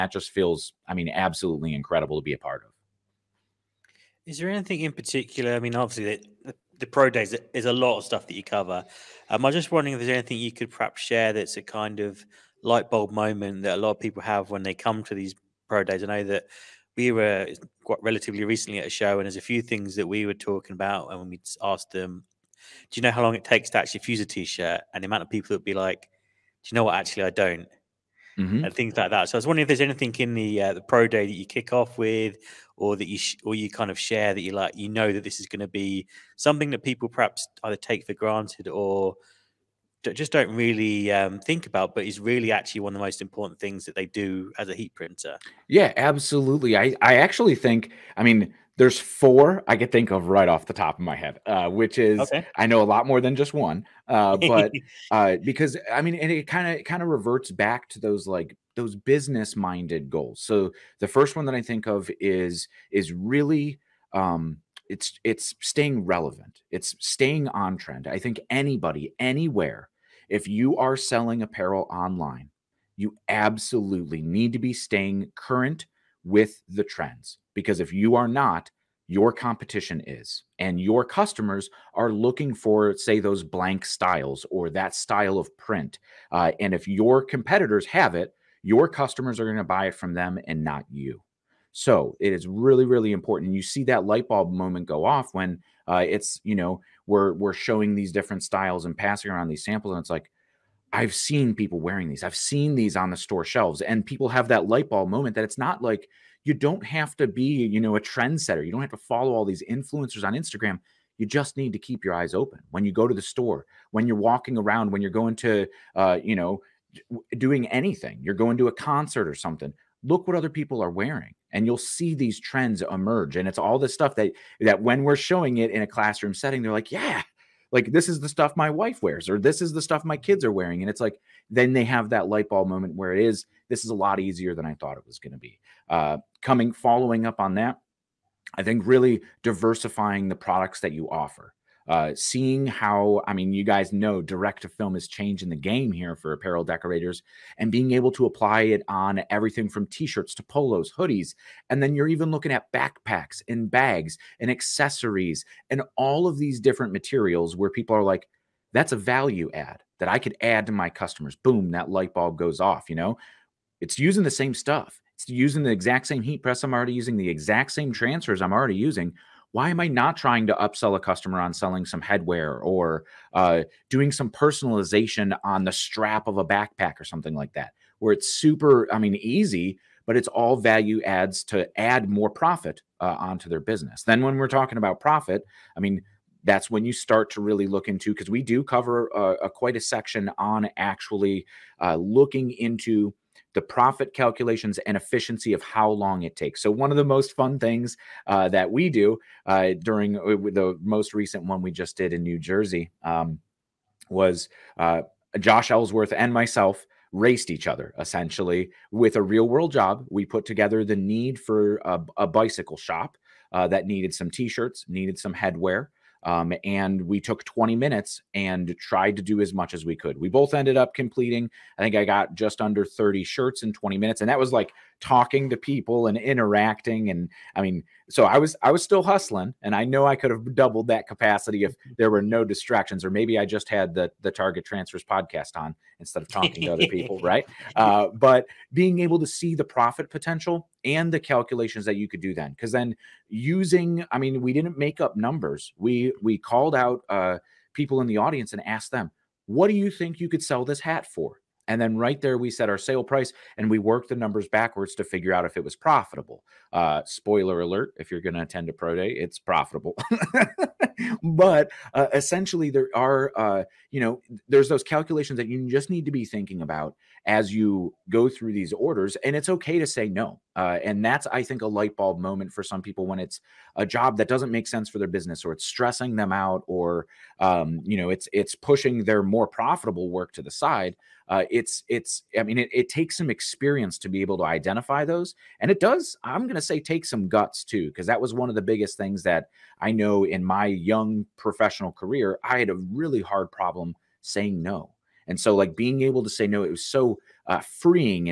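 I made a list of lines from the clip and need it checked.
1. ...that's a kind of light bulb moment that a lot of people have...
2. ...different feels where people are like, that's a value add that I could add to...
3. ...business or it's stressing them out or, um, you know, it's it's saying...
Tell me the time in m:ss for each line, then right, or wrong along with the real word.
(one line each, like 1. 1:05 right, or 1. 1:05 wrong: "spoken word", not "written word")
1. 0:11 right
2. 2:36 wrong: "materials", not "feels"
3. 4:35 wrong: "pushing", not "saying".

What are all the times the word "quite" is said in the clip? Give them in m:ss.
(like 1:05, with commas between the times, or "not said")
0:17, 3:09.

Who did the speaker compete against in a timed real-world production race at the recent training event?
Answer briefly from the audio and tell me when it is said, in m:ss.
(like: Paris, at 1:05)
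Josh Ellsworth, at 3:25.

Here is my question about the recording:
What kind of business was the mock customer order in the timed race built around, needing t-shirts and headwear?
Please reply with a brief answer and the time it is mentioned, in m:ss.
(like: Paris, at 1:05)
A bicycle shop, at 3:32.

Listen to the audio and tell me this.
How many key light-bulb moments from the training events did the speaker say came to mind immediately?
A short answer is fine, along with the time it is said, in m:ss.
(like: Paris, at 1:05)
4, at 0:48.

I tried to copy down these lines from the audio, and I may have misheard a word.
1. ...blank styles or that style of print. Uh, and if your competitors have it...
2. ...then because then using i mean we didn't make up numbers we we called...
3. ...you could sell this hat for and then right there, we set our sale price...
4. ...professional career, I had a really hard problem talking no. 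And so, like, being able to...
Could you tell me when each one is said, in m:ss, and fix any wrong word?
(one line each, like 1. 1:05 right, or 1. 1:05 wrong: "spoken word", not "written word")
1. 1:23 right
2. 4:02 right
3. 4:10 right
4. 4:51 wrong: "saying", not "talking".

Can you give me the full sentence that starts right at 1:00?
So the first one that I think of is is really um, it's it's staying relevant.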